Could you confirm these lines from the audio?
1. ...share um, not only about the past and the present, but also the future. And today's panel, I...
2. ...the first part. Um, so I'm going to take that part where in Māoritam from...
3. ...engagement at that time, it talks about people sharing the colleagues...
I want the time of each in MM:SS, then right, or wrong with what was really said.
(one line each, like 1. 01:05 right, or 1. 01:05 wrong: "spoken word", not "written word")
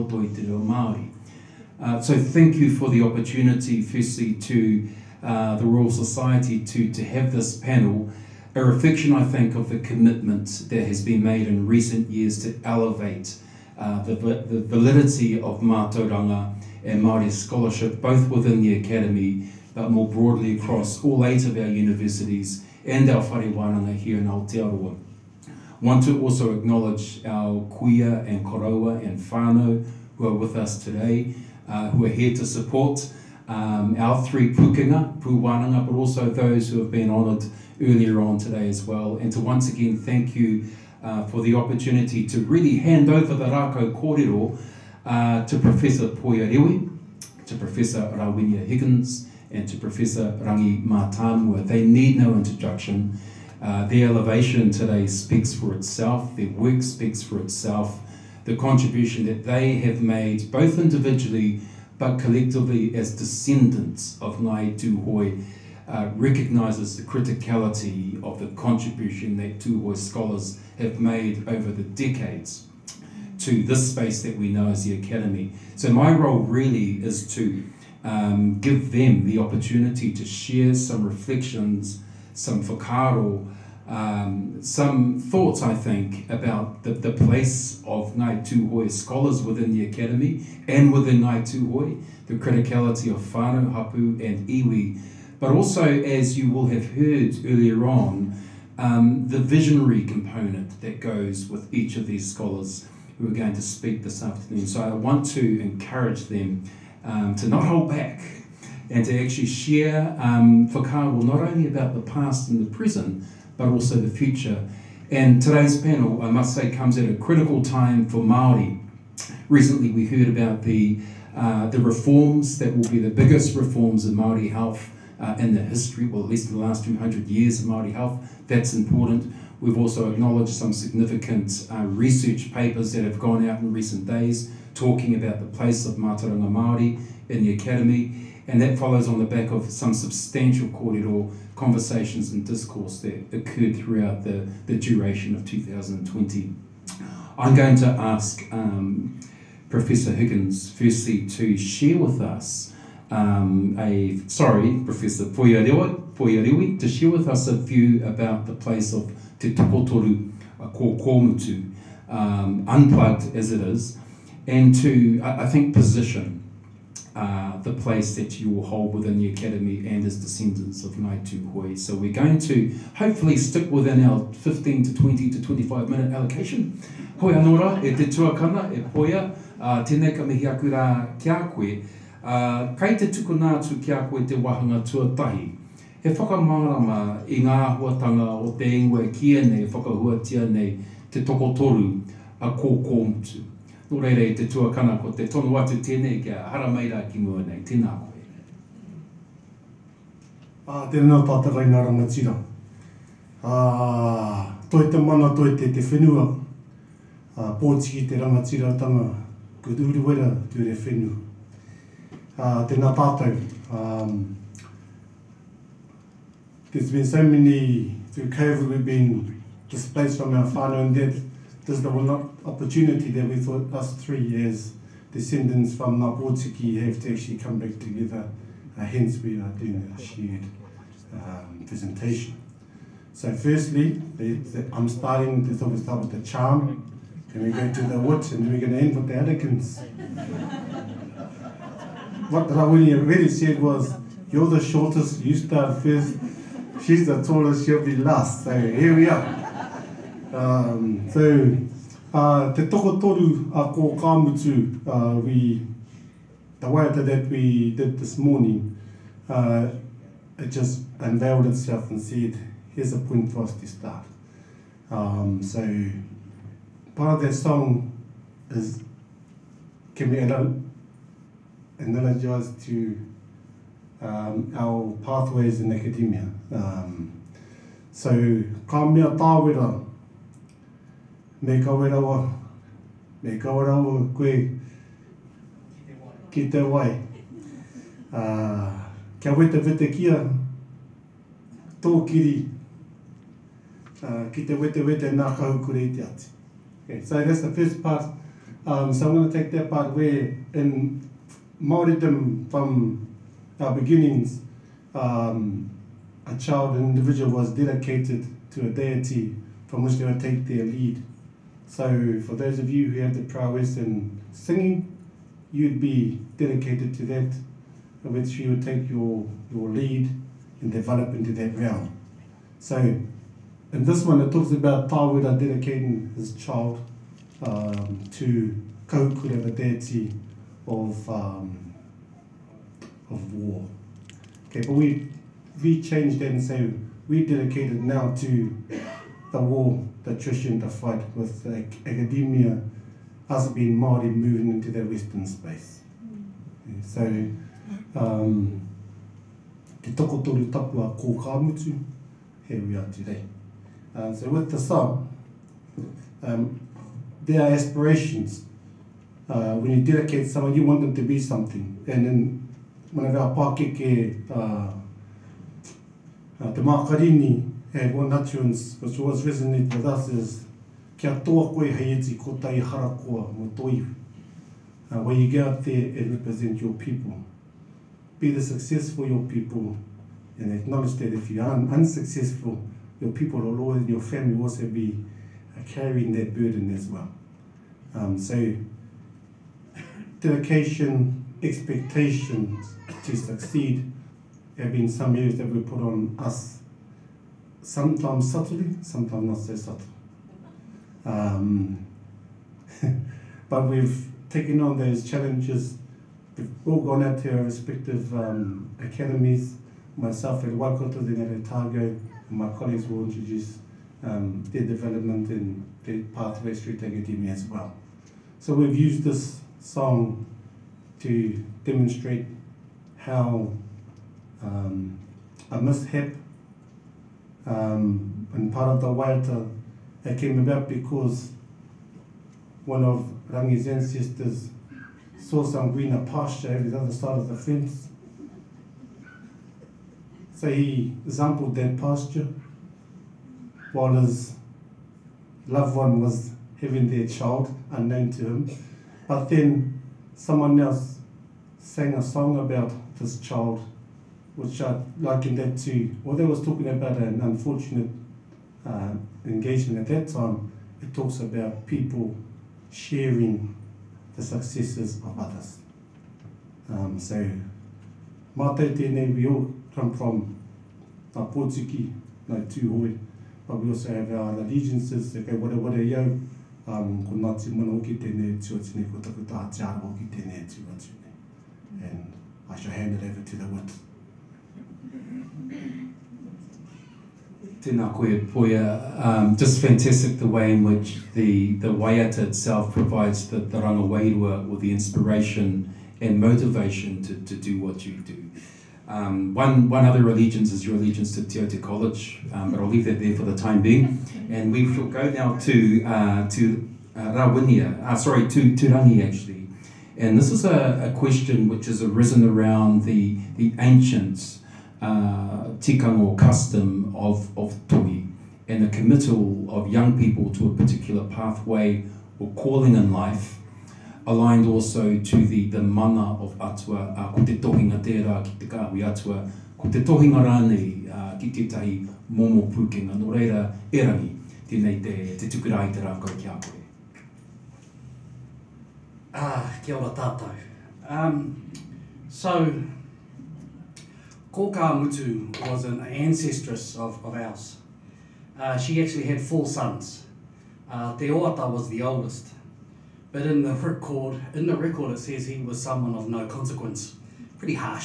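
1. 01:49 right
2. 04:57 right
3. 07:39 wrong: "successes", not "colleagues".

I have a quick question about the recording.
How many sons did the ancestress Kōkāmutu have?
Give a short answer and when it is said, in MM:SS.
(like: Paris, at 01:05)
4, at 09:09.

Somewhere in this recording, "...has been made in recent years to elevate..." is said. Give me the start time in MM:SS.
00:10.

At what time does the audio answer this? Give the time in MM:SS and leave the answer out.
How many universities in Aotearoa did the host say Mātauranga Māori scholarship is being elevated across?
00:21.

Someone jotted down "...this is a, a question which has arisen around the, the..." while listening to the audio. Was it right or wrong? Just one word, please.
right.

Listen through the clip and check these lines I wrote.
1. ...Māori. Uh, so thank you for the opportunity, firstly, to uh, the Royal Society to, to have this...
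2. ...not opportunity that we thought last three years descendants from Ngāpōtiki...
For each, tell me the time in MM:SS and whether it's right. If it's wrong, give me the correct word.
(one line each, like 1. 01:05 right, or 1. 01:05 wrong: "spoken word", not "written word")
1. 00:00 right
2. 03:42 right.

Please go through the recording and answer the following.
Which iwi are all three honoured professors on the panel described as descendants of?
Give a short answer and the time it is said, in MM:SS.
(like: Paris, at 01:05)
Ngāi Tūhoe, at 01:04.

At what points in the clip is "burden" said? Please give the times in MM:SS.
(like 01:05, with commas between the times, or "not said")
06:26.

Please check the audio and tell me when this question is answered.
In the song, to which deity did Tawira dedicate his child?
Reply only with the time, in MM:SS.
05:28.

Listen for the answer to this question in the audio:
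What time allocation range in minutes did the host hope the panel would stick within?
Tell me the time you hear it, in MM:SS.
02:54.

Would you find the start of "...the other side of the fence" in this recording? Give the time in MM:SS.
07:16.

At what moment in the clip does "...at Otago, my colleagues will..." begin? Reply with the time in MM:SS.
06:51.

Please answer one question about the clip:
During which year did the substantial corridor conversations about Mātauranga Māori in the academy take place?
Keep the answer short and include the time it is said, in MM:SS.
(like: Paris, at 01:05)
2020, at 02:25.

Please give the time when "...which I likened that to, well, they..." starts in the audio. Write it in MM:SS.
07:34.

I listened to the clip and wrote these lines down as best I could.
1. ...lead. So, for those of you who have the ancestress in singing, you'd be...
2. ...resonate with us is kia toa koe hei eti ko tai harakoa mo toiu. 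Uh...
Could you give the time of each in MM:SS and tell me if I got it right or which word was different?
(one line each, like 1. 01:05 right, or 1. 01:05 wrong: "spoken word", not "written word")
1. 05:10 wrong: "prowess", not "ancestress"
2. 06:09 right.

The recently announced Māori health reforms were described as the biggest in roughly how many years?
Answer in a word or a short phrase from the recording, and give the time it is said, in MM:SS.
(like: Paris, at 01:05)
200 years, at 02:06.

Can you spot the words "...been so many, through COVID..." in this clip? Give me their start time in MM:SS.
03:36.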